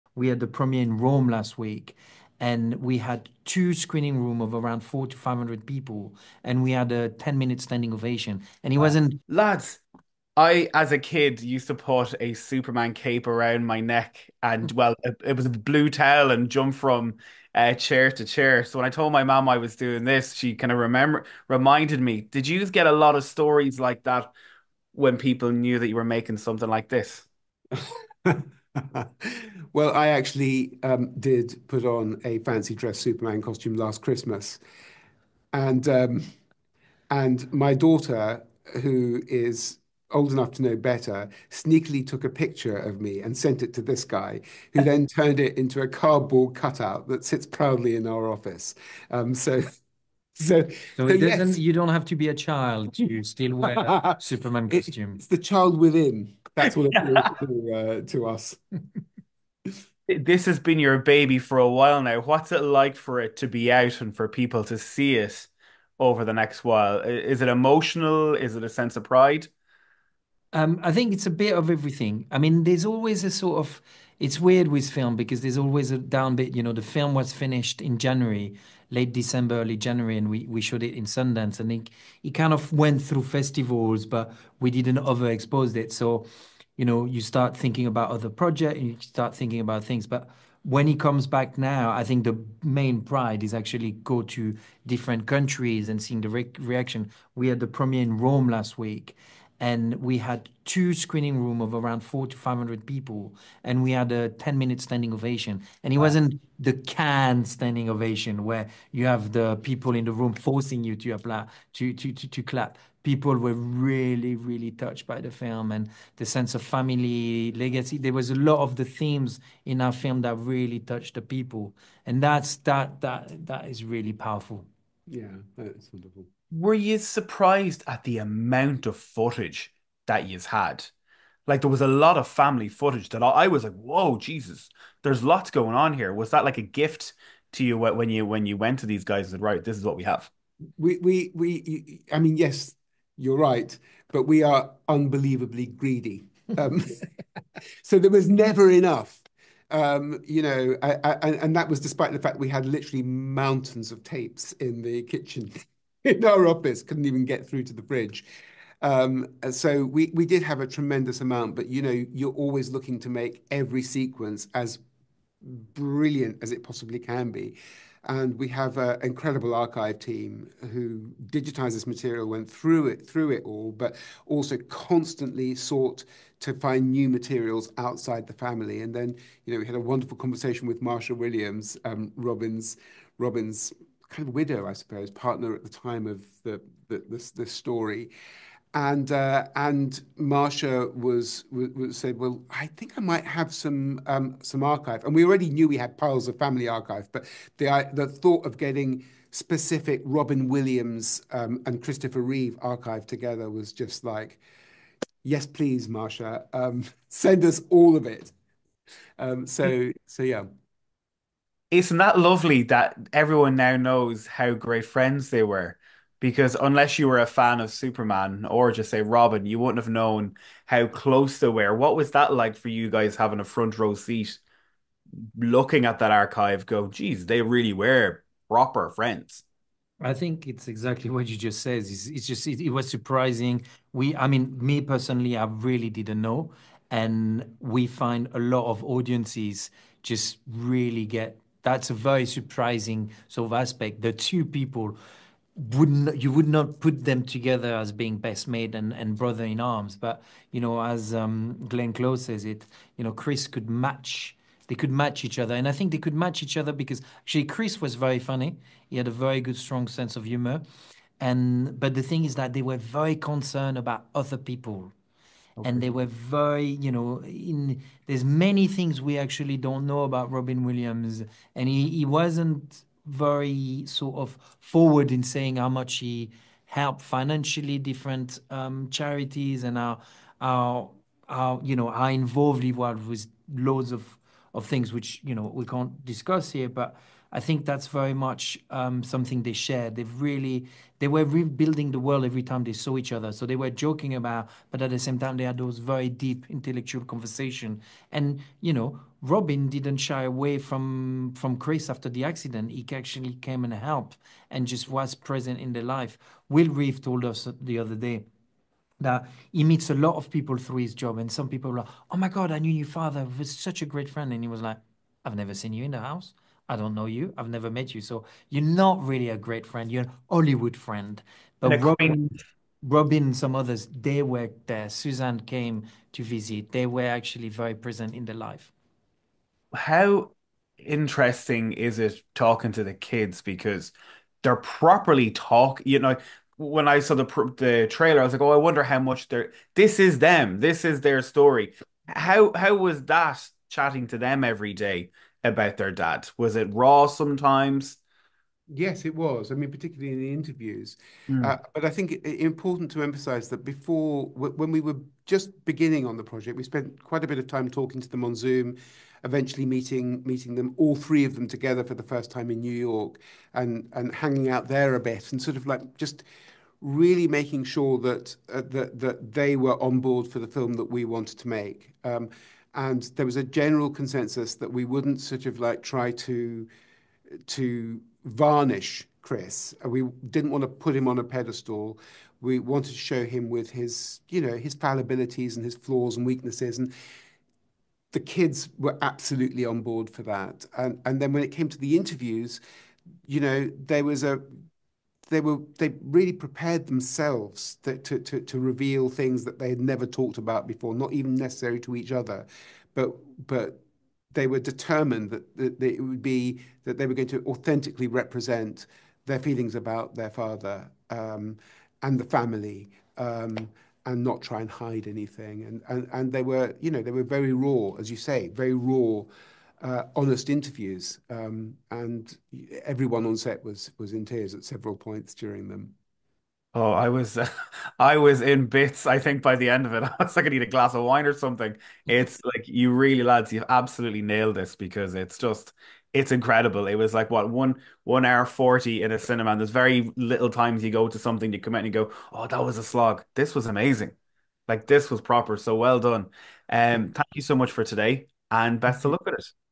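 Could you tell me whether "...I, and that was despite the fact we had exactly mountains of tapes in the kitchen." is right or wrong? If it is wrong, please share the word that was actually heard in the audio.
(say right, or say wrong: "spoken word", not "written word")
wrong: "literally", not "exactly".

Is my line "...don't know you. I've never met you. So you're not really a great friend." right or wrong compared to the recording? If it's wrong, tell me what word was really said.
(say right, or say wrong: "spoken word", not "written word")
right.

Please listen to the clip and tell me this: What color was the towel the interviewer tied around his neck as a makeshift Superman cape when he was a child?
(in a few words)
Blue.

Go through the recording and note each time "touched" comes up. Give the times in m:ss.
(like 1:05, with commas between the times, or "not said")
1:54, 2:00.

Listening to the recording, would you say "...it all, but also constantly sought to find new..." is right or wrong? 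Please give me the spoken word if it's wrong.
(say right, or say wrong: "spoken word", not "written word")
right.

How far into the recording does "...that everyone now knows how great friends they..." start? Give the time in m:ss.
3:32.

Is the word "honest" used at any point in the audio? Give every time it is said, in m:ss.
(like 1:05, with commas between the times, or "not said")
7:00.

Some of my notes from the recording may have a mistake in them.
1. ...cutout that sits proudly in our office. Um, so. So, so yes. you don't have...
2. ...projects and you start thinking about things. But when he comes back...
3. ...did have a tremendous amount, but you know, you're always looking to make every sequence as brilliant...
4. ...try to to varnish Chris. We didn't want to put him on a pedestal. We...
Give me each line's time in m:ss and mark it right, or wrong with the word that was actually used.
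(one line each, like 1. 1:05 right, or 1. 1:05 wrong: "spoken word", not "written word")
1. 0:46 right
2. 1:28 right
3. 2:40 right
4. 6:15 right.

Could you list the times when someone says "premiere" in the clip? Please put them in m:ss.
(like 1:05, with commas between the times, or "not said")
0:00, 1:37.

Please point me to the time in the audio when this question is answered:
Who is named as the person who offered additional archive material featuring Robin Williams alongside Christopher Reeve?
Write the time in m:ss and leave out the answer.
3:00.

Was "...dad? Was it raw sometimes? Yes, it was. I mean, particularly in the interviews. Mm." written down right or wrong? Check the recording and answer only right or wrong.
right.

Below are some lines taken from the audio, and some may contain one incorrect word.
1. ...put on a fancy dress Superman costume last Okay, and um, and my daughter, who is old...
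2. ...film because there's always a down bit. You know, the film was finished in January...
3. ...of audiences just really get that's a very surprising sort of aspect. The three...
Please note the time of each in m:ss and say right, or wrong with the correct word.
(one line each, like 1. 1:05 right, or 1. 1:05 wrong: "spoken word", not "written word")
1. 0:31 wrong: "Christmas", not "Okay"
2. 1:14 right
3. 3:58 wrong: "two", not "three".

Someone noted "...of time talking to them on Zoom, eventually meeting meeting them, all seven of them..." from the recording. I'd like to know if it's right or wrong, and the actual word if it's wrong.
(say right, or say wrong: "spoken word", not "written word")
wrong: "three", not "seven".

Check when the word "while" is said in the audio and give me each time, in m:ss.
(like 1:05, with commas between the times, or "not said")
1:01, 1:06.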